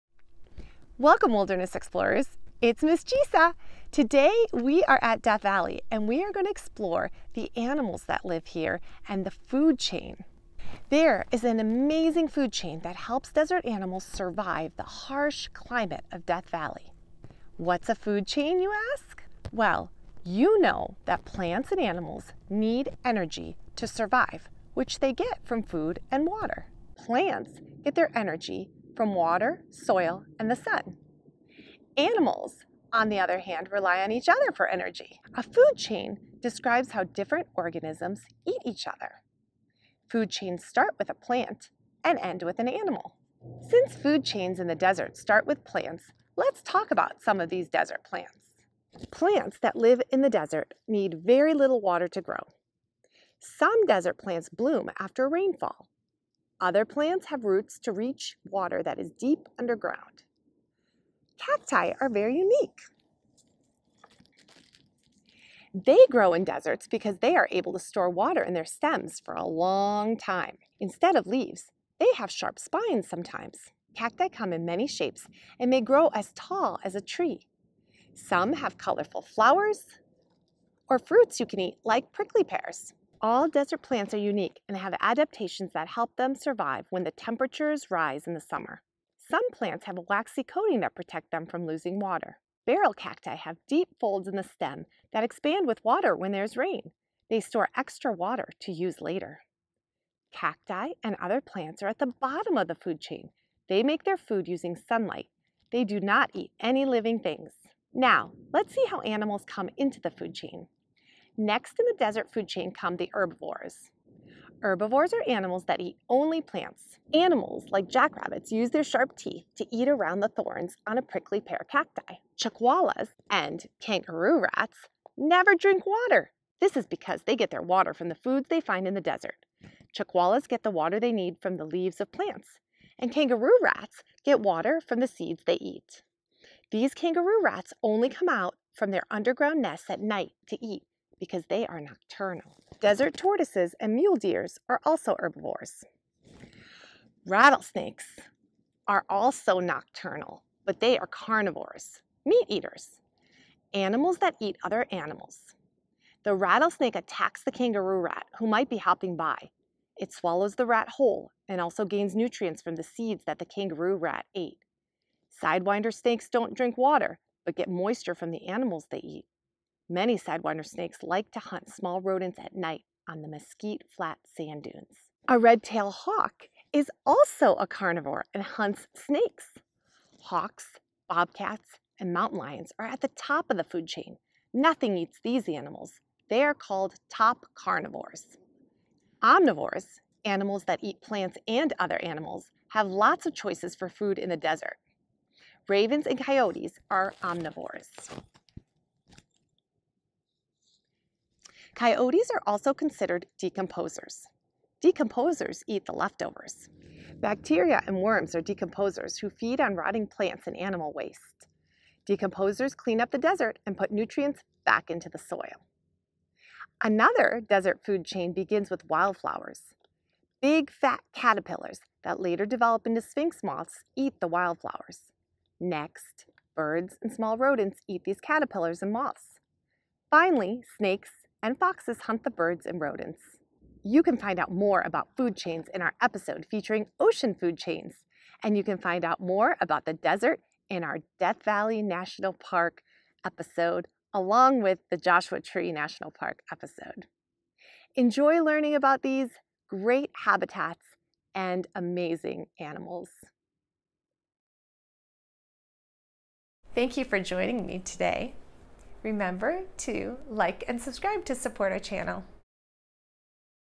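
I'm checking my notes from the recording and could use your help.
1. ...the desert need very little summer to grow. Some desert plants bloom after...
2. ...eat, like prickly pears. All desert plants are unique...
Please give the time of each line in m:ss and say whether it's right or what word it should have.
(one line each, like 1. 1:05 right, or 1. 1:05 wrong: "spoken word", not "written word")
1. 0:50 wrong: "water", not "summer"
2. 1:21 right.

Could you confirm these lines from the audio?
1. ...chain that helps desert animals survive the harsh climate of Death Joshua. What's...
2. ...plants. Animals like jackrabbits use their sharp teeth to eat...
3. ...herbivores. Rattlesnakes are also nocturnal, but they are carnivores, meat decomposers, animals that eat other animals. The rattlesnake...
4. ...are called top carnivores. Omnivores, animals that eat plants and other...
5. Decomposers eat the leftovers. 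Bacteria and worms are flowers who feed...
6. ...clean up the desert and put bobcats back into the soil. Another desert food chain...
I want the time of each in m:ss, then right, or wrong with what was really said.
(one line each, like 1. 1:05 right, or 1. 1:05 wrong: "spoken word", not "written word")
1. 0:12 wrong: "Valley", not "Joshua"
2. 1:56 right
3. 2:25 wrong: "eaters", not "decomposers"
4. 3:06 right
5. 3:24 wrong: "decomposers", not "flowers"
6. 3:32 wrong: "nutrients", not "bobcats".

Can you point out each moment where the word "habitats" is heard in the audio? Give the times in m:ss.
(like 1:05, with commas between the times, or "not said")
4:10.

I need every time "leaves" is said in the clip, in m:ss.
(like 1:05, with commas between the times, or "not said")
1:11, 2:11.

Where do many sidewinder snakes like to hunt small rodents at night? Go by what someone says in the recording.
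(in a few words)
Mesquite flat sand dunes.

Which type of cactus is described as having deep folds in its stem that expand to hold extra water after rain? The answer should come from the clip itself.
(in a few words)
Barrel cacti.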